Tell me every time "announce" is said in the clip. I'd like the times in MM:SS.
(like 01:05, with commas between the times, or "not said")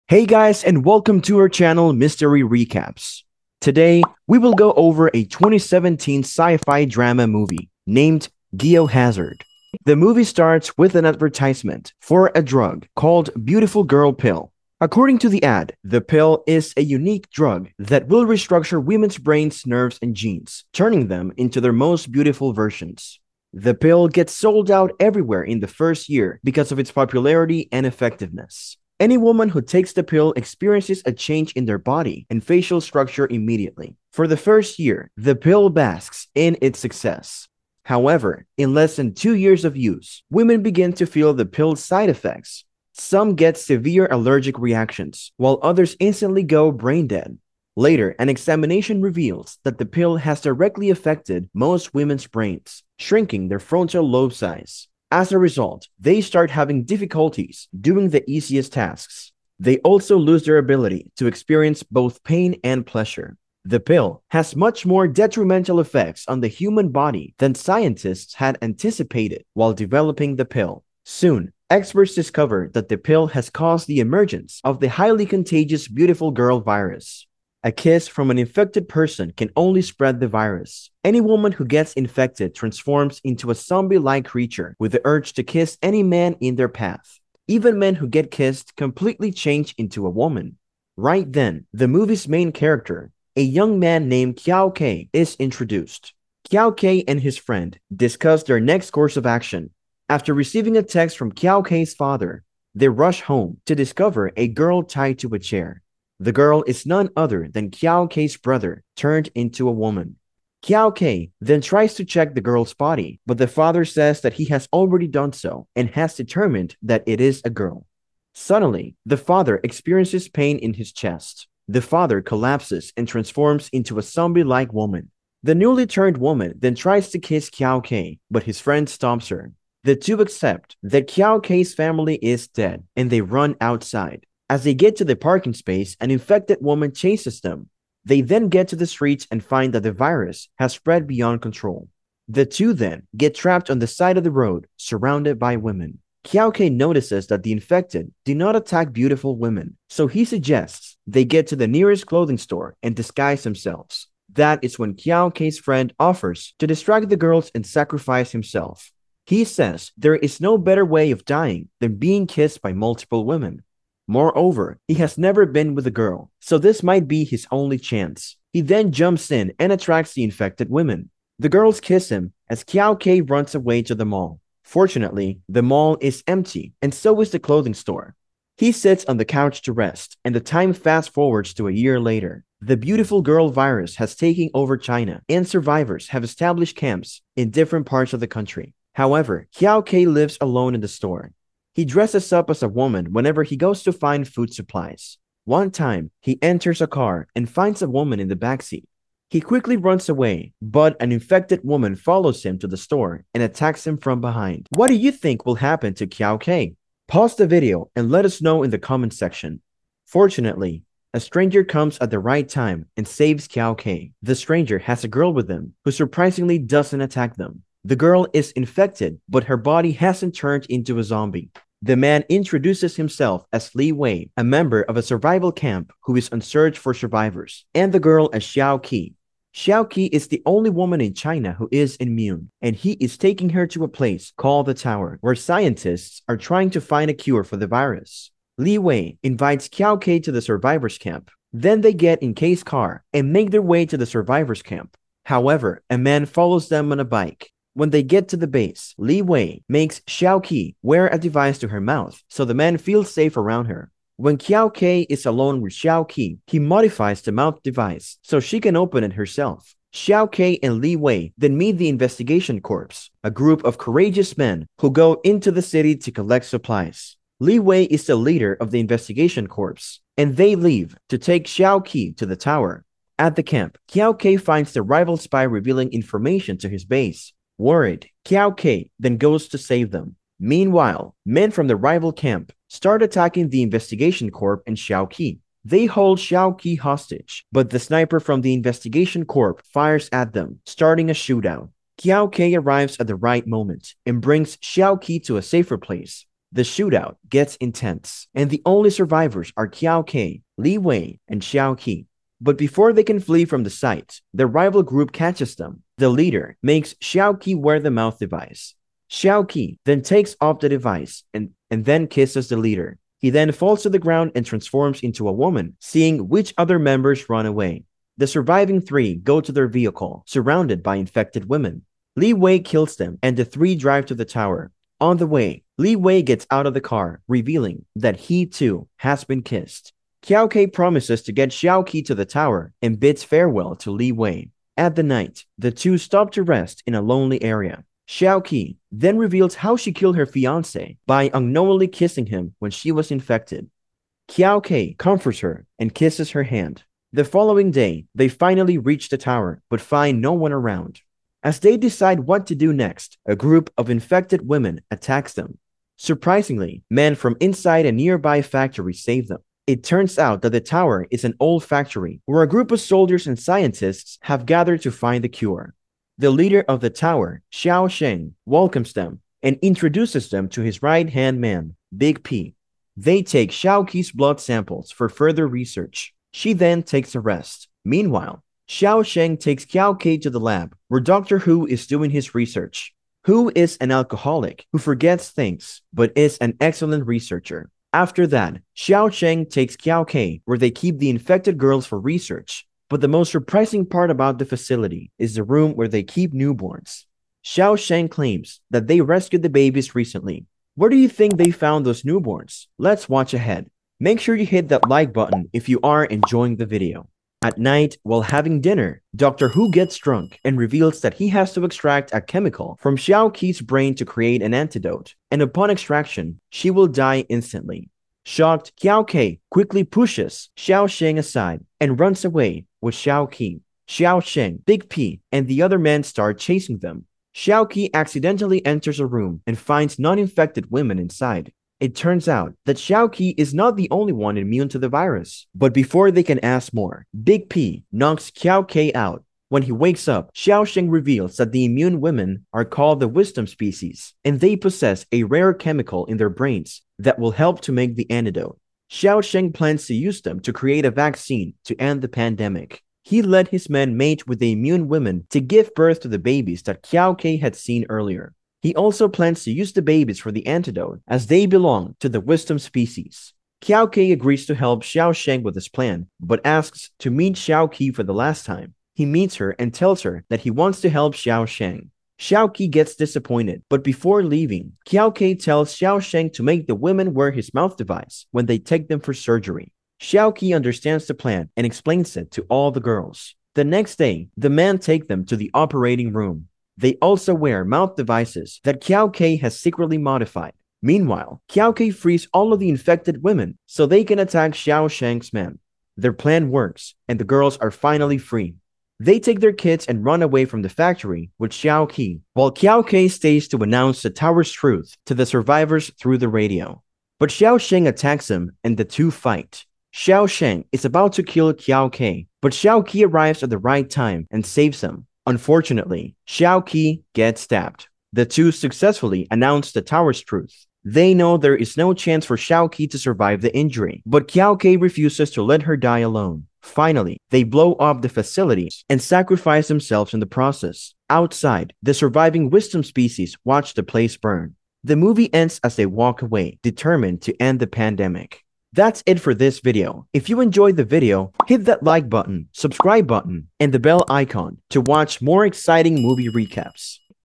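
08:23, 08:39.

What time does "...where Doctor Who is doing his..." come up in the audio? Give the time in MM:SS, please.
06:20.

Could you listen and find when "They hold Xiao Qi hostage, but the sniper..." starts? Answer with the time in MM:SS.
04:45.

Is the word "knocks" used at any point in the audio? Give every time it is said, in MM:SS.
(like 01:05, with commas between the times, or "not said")
07:17.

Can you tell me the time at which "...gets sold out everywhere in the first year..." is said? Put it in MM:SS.
00:24.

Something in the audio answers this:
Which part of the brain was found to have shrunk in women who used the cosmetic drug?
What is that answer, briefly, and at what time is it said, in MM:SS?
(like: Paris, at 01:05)
frontal lobe, at 00:53.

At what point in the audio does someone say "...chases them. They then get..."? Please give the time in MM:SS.
02:16.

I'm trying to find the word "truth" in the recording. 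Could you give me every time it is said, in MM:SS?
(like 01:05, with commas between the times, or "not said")
08:24, 08:40.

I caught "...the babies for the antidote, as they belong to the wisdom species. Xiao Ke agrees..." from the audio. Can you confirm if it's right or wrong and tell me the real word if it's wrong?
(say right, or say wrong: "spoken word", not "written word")
right.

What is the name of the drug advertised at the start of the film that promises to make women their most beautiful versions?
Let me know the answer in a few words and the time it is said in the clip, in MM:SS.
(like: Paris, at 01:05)
Beautiful Girl Pill, at 00:13.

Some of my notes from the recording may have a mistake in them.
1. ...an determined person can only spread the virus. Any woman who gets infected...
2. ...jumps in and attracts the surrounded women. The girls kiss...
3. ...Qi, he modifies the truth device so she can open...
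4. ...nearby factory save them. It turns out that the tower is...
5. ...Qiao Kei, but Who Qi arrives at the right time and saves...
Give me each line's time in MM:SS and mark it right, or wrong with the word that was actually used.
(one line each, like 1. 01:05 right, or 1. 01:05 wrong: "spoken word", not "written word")
1. 01:18 wrong: "infected", not "determined"
2. 02:48 wrong: "infected", not "surrounded"
3. 04:16 wrong: "mouth", not "truth"
4. 05:57 right
5. 08:31 wrong: "Xiao", not "Who".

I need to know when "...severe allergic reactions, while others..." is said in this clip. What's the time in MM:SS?
00:43.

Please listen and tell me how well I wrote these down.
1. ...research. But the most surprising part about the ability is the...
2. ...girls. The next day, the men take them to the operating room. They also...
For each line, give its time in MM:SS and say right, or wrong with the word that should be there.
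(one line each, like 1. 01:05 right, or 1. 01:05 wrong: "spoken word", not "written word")
1. 06:31 wrong: "facility", not "ability"
2. 08:02 right.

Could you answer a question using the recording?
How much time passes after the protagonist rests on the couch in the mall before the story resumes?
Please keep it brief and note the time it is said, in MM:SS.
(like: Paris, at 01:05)
a year, at 03:01.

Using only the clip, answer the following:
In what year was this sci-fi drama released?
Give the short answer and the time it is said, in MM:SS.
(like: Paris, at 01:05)
2017, at 00:05.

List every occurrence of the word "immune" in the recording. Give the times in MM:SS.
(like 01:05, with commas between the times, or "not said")
03:51, 07:14, 07:21, 07:34.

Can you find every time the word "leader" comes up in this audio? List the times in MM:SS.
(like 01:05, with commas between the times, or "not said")
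04:28, 05:06, 05:12, 06:06.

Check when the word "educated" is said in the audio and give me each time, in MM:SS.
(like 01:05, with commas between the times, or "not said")
not said.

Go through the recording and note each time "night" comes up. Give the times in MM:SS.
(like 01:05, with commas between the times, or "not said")
05:35, 06:47.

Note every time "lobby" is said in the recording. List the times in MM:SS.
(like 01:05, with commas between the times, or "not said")
not said.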